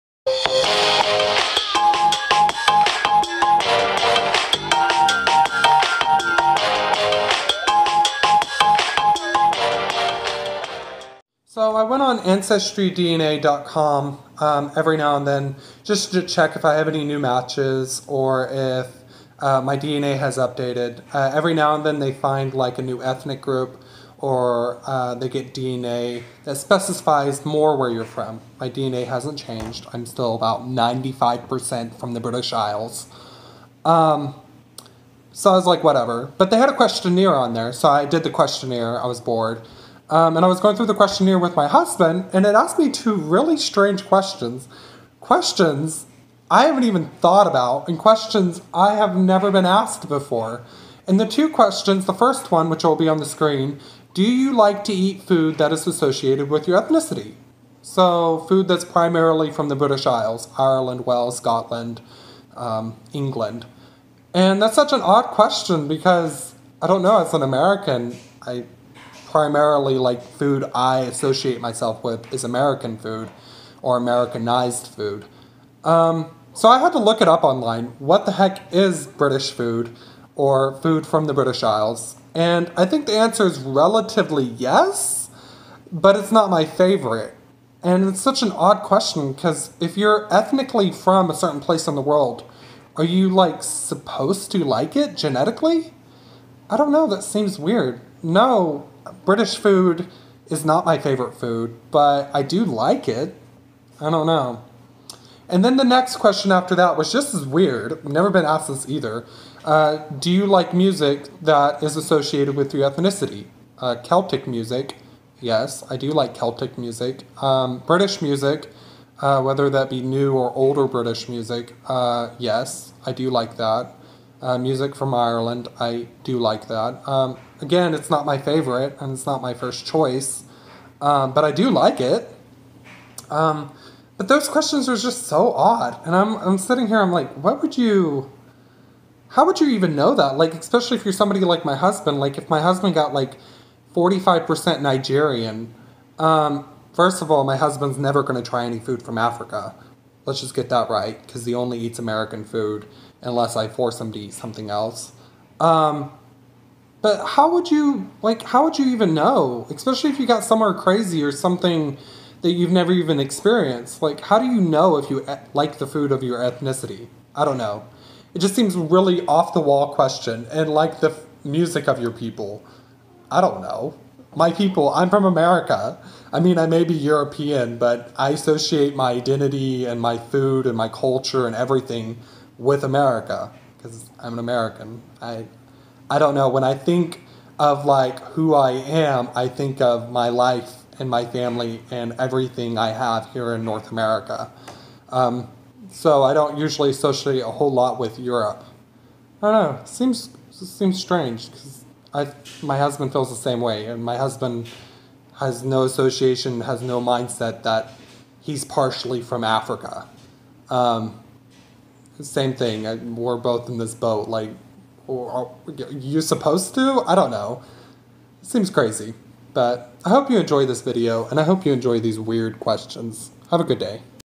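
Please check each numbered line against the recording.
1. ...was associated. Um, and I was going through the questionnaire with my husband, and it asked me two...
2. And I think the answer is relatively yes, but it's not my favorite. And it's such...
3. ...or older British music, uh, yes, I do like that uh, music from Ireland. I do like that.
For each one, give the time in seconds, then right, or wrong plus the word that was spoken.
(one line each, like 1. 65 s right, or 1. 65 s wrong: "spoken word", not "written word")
1. 39 s wrong: "bored", not "associated"
2. 82 s right
3. 120 s right.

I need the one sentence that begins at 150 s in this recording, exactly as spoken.
Let's just get that right because he only eats American food unless I force him to eat something else.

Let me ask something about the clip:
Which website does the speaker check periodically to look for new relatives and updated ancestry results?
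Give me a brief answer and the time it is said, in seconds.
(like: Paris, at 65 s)
AncestryDNA.com, at 12 s.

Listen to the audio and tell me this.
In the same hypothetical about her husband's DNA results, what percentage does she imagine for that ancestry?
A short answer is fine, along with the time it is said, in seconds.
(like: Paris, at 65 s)
45%, at 143 s.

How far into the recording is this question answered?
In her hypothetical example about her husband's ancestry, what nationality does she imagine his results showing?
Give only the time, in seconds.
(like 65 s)
144 s.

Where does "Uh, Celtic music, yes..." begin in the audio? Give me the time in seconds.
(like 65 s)
113 s.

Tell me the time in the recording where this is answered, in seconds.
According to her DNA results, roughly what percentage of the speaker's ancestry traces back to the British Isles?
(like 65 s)
30 s.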